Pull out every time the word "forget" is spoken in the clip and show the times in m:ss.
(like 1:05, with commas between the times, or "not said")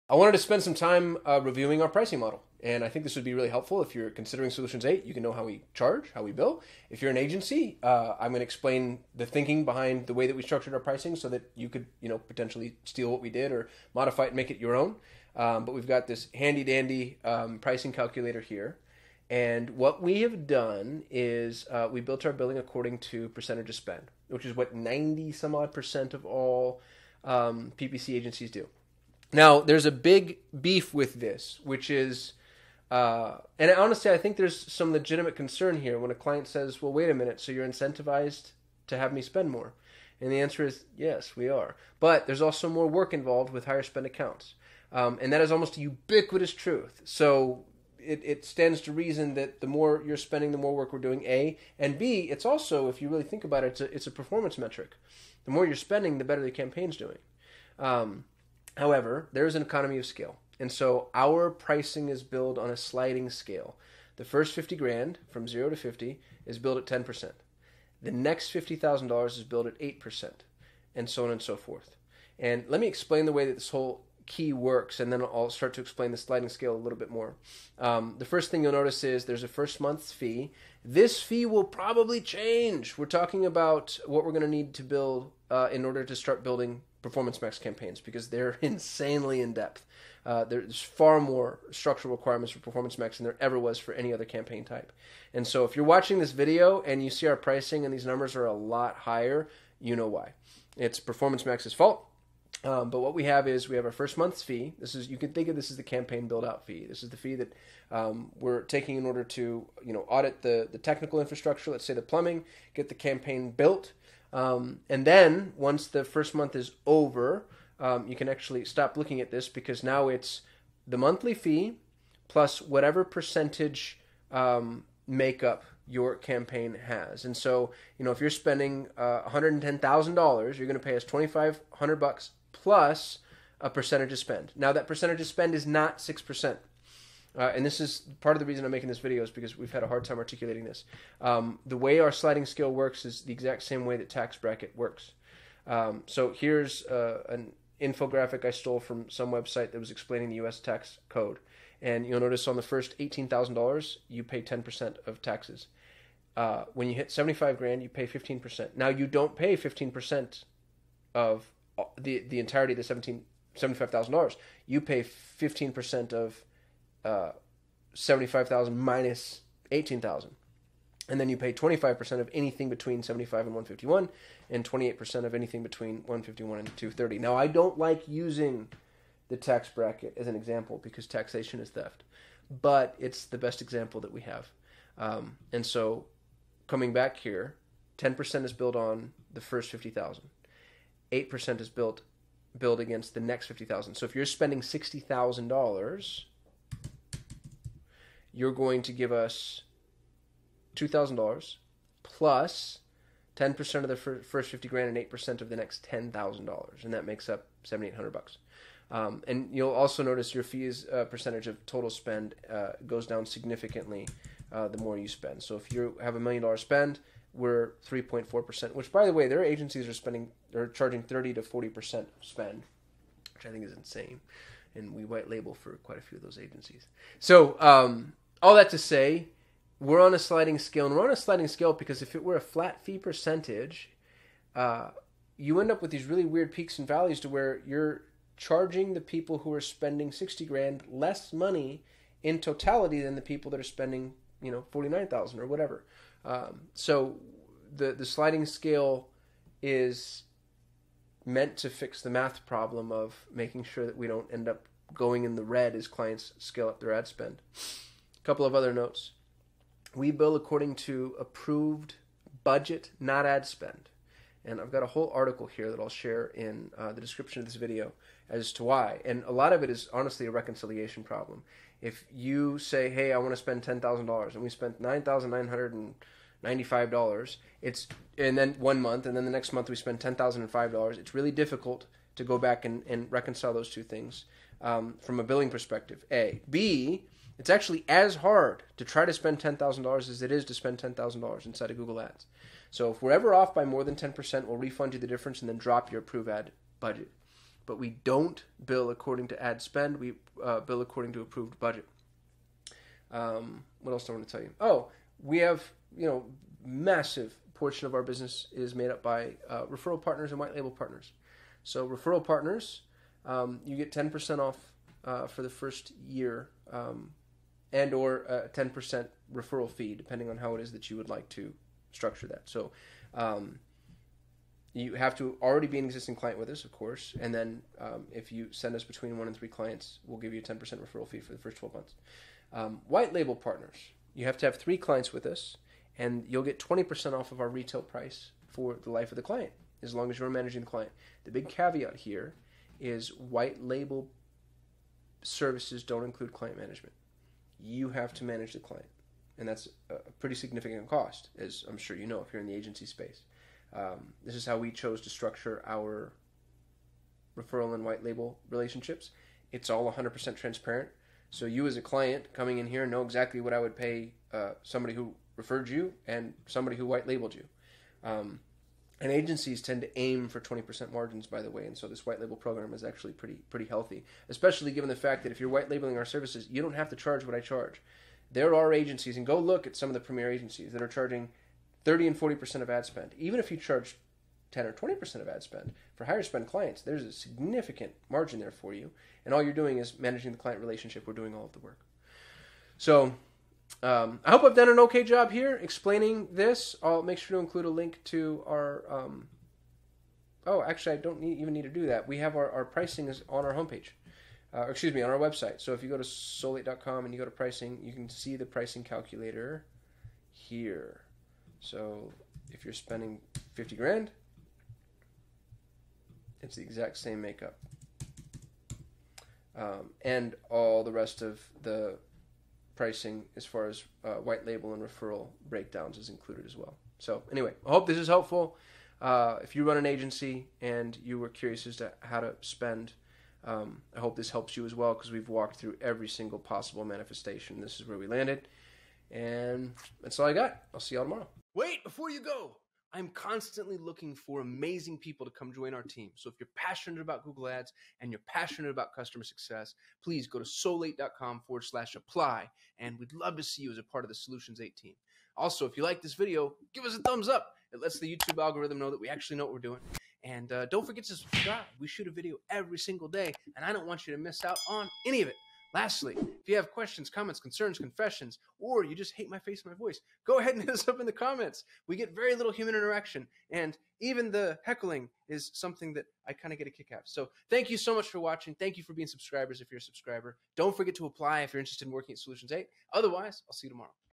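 7:40, 8:00.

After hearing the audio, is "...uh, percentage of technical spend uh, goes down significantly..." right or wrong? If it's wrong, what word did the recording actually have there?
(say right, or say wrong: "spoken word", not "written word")
wrong: "total", not "technical".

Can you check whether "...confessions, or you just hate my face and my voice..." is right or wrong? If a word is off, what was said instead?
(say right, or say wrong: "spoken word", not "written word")
right.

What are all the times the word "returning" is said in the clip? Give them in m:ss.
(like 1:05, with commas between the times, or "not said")
not said.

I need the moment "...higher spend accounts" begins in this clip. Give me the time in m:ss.
0:43.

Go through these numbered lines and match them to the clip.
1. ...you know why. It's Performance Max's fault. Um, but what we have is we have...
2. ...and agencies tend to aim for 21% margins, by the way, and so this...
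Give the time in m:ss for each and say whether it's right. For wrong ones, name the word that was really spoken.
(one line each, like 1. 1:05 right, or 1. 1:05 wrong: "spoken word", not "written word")
1. 1:39 right
2. 6:09 wrong: "20", not "21".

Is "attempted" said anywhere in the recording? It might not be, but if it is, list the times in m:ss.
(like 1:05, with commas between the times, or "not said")
not said.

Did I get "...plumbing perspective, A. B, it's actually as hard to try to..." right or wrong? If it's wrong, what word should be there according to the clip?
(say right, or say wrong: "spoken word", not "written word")
wrong: "billing", not "plumbing".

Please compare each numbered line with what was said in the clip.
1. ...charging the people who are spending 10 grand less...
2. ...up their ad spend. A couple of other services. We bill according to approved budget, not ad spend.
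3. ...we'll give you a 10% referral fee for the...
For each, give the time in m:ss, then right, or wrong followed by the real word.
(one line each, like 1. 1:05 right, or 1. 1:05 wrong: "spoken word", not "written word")
1. 3:58 wrong: "60", not "10"
2. 4:16 wrong: "notes", not "services"
3. 5:30 right.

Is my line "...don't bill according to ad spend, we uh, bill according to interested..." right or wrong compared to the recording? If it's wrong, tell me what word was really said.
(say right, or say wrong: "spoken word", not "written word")
wrong: "approved", not "interested".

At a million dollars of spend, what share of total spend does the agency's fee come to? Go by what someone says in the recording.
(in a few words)
3.4%.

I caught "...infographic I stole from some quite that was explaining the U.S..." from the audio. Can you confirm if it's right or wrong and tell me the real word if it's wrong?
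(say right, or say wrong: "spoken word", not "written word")
wrong: "website", not "quite".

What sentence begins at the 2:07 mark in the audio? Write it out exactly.
And so, you know, if you're spending uh, $110,000, you're going to pay us 2,500 bucks plus a percentage of spend.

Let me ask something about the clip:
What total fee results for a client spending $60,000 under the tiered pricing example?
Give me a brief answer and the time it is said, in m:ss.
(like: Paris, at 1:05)
$7,800, at 3:27.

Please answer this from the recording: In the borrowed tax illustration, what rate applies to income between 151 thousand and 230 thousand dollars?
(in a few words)
28%.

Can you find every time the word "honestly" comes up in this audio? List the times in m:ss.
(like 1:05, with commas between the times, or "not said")
0:33, 4:29.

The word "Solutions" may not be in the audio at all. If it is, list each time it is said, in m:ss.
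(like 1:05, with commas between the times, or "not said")
0:04, 7:34, 8:02.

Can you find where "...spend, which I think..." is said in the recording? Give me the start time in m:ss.
3:42.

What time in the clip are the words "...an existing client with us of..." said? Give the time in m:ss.
5:25.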